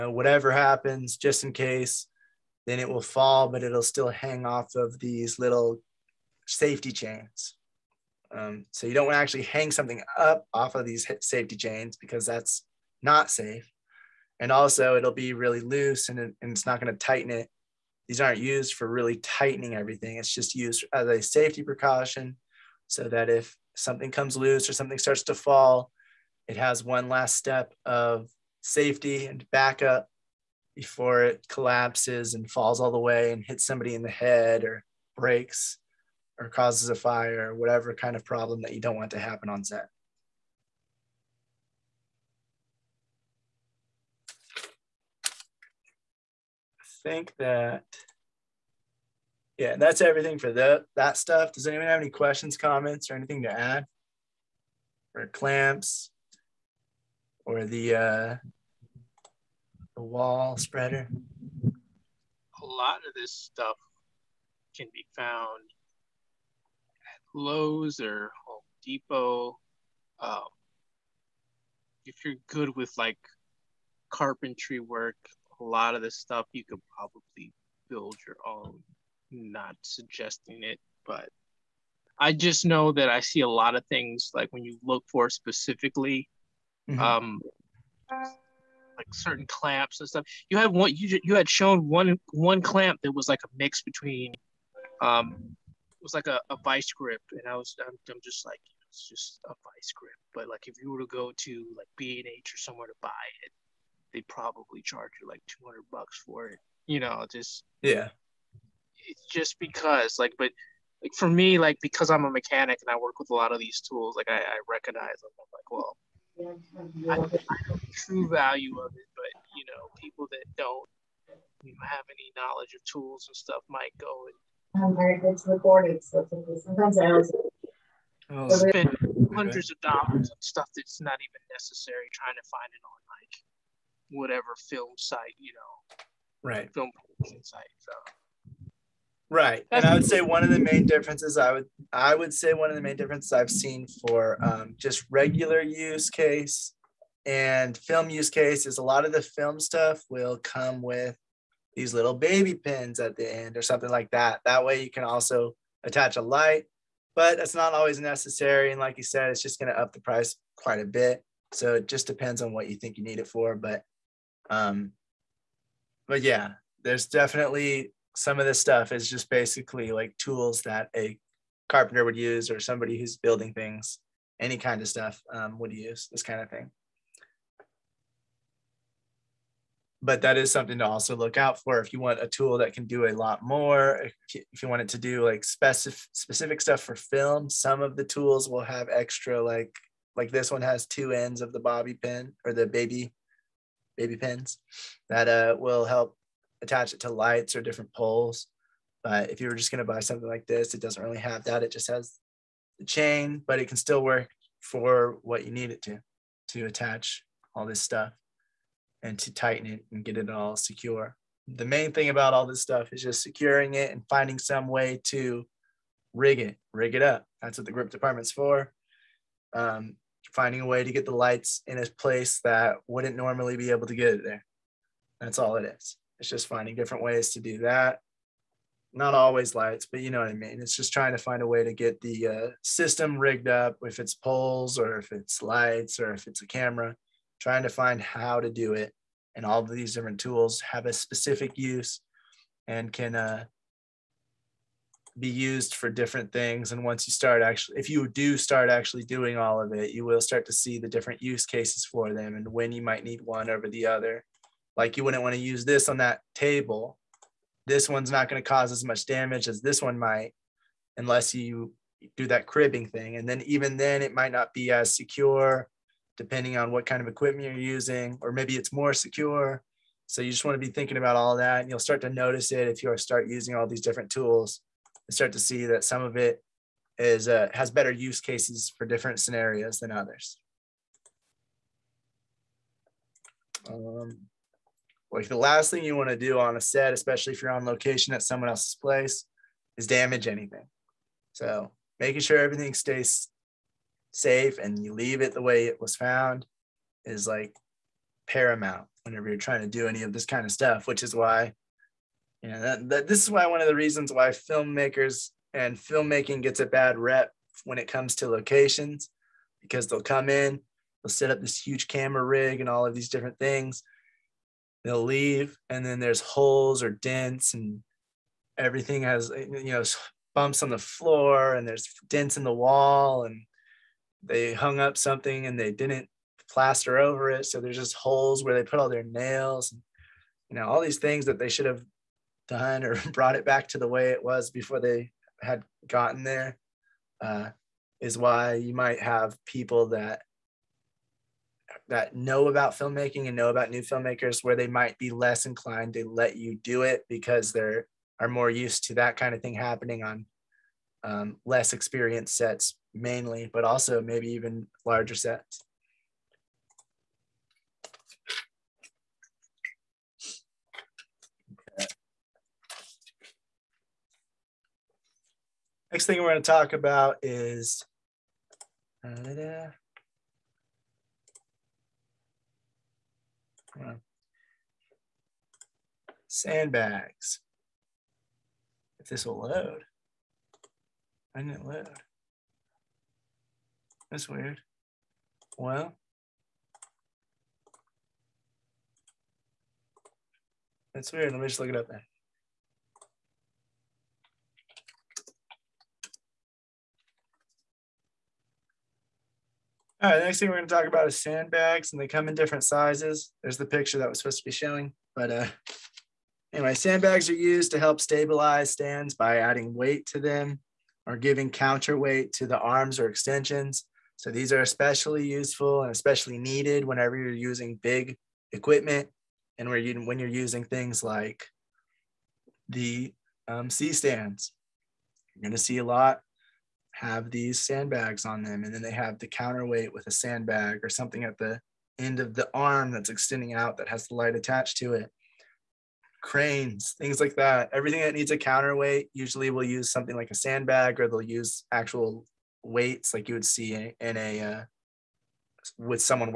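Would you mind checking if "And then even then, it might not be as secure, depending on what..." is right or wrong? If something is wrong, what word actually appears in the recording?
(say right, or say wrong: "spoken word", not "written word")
right.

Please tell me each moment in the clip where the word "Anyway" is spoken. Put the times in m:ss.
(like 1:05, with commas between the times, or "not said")
6:46.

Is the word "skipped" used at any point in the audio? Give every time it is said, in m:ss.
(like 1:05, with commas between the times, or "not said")
not said.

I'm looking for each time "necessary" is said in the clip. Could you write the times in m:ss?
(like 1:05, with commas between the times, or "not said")
2:11, 2:37.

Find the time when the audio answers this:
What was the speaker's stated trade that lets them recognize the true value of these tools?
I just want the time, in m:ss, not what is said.
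1:52.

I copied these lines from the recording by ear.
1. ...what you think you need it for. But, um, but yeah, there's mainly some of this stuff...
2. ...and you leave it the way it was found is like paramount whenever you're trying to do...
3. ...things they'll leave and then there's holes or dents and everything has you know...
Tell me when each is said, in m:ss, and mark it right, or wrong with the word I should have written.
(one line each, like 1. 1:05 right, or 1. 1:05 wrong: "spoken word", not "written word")
1. 2:42 wrong: "definitely", not "mainly"
2. 4:54 right
3. 5:13 right.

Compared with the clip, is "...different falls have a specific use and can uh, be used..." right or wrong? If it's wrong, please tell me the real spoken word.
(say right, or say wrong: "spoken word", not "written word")
wrong: "tools", not "falls".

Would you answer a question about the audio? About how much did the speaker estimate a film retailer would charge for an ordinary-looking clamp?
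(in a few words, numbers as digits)
$200.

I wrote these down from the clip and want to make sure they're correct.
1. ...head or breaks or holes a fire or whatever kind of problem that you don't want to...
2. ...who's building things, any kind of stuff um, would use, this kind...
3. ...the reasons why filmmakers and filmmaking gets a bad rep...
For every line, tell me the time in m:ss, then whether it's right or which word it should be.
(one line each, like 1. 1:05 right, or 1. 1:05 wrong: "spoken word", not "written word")
1. 0:34 wrong: "causes", not "holes"
2. 2:52 right
3. 5:03 right.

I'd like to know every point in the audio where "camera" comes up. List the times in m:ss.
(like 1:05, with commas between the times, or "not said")
3:56, 5:11.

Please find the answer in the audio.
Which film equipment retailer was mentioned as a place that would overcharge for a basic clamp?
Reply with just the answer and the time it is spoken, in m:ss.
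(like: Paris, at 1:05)
B and H, at 1:41.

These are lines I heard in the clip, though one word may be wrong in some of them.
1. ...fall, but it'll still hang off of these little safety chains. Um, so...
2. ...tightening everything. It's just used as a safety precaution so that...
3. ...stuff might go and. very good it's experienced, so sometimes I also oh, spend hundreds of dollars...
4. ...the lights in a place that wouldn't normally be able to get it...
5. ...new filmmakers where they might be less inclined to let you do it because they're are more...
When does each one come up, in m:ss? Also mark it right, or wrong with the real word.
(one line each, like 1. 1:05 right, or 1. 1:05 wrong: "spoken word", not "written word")
1. 0:03 right
2. 0:19 right
3. 2:03 wrong: "recorded", not "experienced"
4. 3:41 right
5. 5:43 right.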